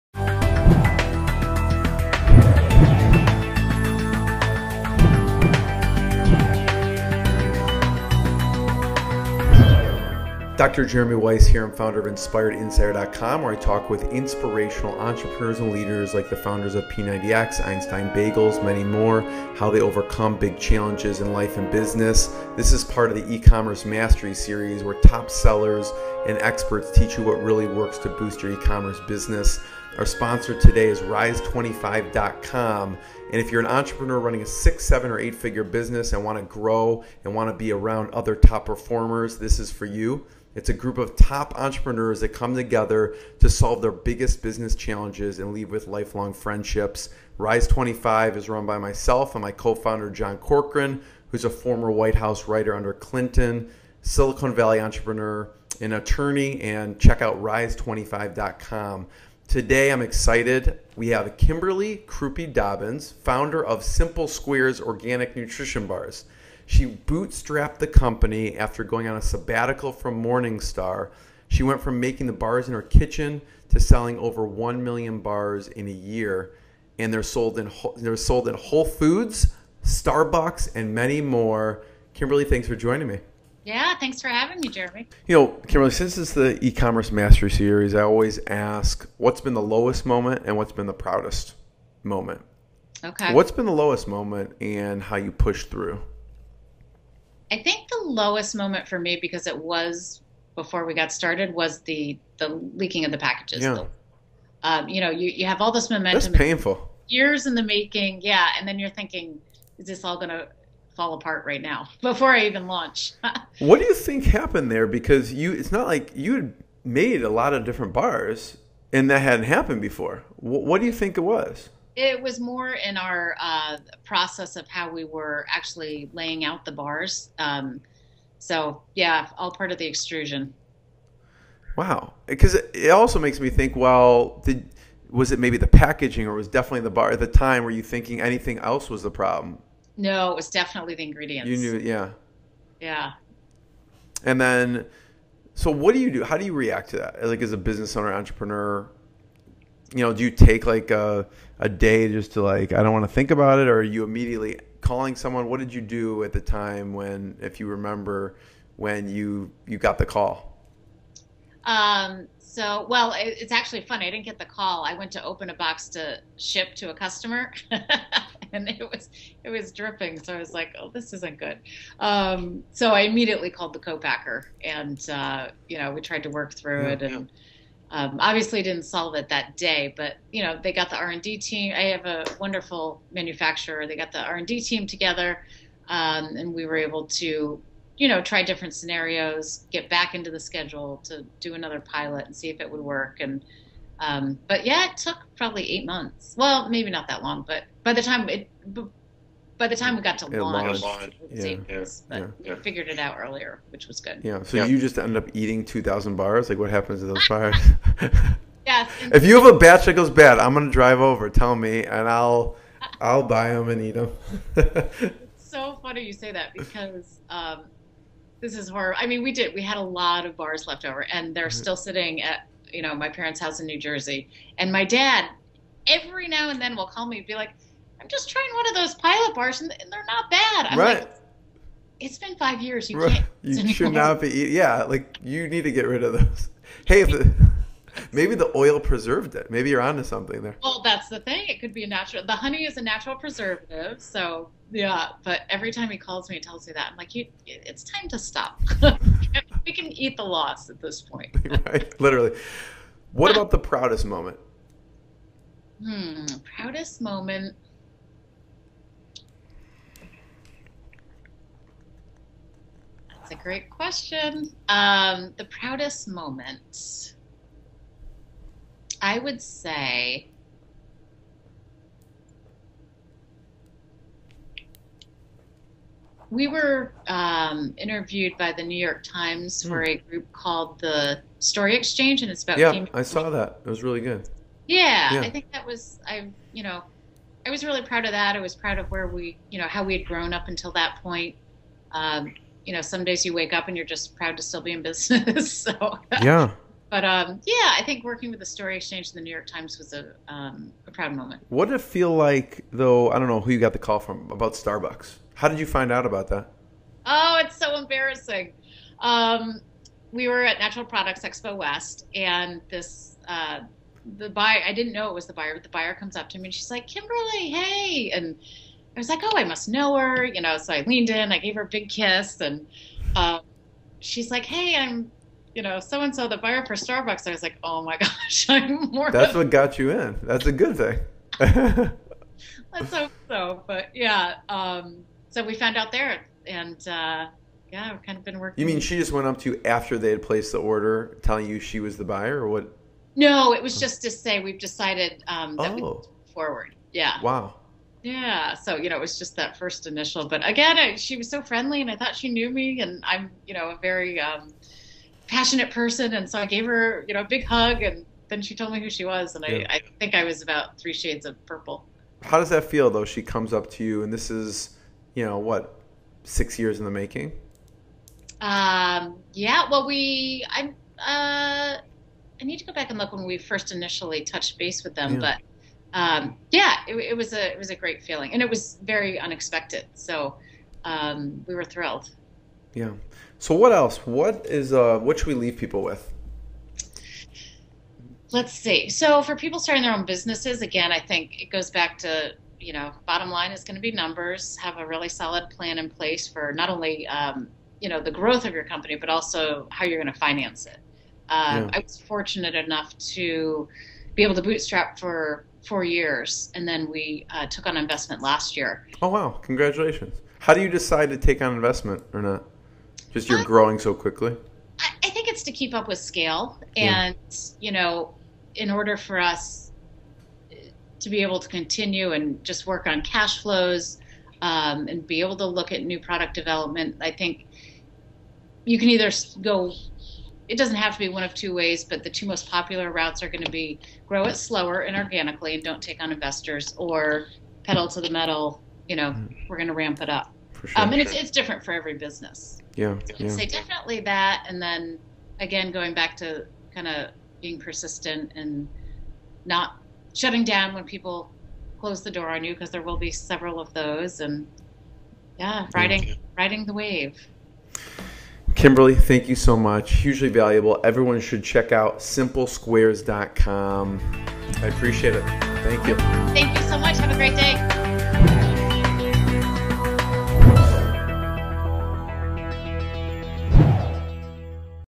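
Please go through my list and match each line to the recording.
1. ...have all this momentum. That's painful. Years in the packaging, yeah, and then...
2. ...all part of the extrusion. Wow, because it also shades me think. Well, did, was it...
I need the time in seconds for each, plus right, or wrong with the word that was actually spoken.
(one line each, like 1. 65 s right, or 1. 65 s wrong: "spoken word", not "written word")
1. 105 s wrong: "making", not "packaging"
2. 129 s wrong: "makes", not "shades".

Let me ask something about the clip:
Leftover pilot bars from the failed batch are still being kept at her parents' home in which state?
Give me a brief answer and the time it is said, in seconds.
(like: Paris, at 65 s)
New Jersey, at 223 s.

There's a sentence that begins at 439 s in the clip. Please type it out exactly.
we're going to ramp it up.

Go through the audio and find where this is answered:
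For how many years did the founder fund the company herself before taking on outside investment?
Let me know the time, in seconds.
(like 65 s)
405 s.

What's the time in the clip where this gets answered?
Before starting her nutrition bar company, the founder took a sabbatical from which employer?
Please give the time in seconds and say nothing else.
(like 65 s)
70 s.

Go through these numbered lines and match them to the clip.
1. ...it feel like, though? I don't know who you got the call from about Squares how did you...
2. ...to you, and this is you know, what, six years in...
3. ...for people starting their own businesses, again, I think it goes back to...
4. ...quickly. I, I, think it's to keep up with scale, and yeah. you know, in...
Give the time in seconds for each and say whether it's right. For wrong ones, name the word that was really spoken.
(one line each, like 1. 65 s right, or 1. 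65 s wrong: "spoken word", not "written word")
1. 301 s wrong: "Starbucks", not "Squares"
2. 363 s right
3. 389 s right
4. 413 s right.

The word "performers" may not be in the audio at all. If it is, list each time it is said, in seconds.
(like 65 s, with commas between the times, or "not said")
38 s.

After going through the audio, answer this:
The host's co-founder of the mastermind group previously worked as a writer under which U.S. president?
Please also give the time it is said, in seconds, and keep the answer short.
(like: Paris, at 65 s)
Clinton, at 52 s.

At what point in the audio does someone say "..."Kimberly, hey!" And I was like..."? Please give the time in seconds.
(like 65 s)
316 s.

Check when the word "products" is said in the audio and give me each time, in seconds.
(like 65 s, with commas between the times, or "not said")
310 s, 425 s.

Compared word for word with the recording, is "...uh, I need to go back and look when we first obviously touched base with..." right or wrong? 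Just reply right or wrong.
wrong.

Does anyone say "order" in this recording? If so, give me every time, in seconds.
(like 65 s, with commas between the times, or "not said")
340 s, 418 s.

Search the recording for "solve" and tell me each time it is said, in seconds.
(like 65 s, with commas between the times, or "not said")
43 s, 178 s.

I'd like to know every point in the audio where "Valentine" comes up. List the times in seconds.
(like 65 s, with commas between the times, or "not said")
not said.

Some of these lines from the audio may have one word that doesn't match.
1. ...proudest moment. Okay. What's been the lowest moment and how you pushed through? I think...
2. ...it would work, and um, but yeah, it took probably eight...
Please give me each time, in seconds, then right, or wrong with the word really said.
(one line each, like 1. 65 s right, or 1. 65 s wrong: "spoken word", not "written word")
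1. 90 s right
2. 192 s right.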